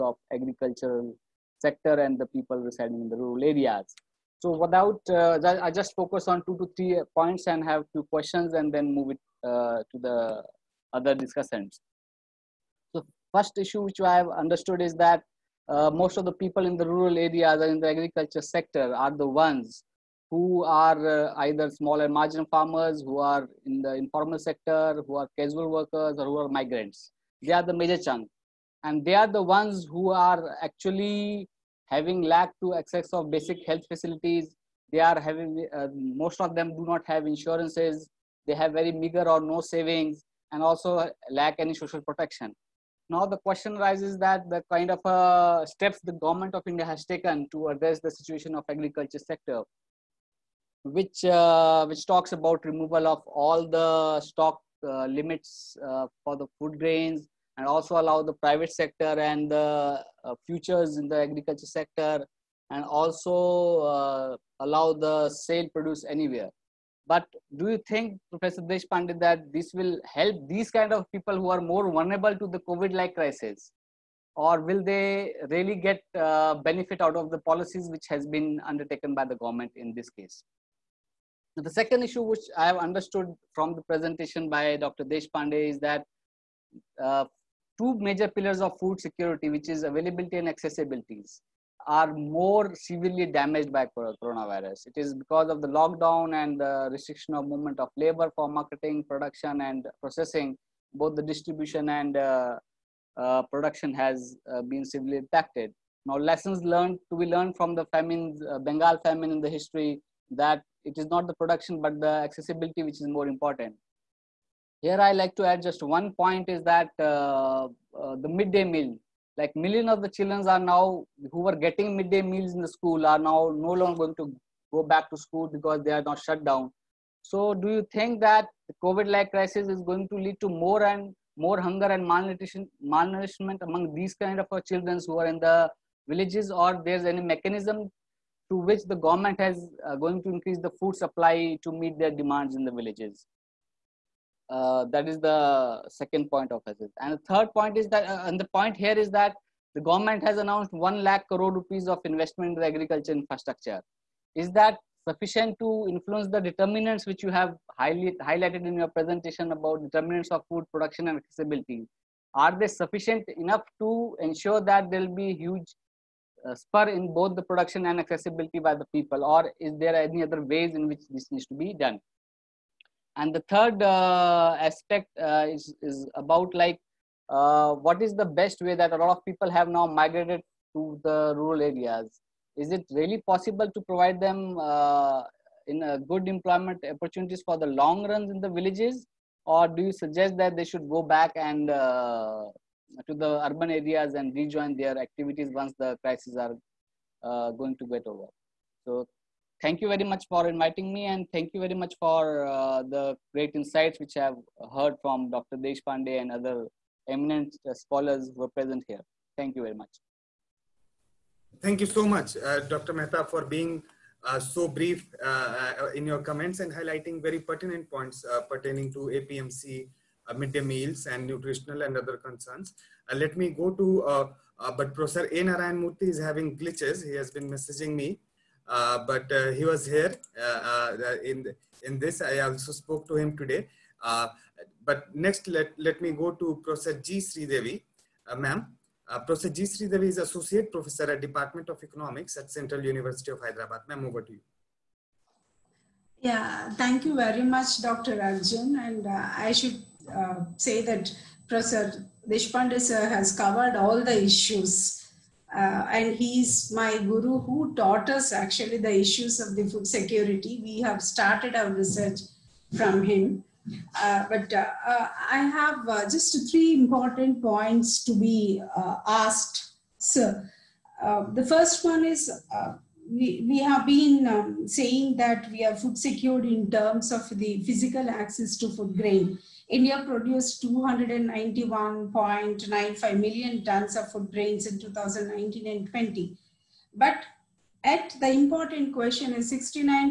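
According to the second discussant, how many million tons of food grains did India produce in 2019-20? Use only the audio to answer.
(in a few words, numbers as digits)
291.95.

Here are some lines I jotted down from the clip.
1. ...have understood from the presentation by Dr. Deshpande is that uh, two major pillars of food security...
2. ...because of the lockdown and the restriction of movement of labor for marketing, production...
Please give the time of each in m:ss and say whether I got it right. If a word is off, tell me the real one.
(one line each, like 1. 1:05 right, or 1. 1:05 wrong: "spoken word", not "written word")
1. 1:22 right
2. 1:35 right.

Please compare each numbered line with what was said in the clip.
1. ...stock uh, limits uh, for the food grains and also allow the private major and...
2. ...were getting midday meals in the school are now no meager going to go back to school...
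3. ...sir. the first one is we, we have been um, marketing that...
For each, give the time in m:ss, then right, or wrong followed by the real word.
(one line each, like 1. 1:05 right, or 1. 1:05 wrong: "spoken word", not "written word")
1. 0:54 wrong: "sector", not "major"
2. 2:01 wrong: "longer", not "meager"
3. 4:29 wrong: "saying", not "marketing".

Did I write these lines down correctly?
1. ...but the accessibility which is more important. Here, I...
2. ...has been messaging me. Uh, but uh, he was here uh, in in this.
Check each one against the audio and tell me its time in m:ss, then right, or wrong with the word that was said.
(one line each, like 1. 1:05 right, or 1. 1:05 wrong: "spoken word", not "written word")
1. 1:51 right
2. 3:47 right.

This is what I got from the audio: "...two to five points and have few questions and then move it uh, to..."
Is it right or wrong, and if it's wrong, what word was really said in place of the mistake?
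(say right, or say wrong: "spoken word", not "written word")
wrong: "three", not "five".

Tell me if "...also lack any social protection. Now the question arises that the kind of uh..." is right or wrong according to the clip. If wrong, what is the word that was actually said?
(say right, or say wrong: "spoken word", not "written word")
right.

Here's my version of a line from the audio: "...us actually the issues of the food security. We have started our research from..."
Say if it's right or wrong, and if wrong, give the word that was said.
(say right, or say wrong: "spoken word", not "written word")
right.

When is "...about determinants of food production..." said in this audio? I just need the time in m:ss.
2:39.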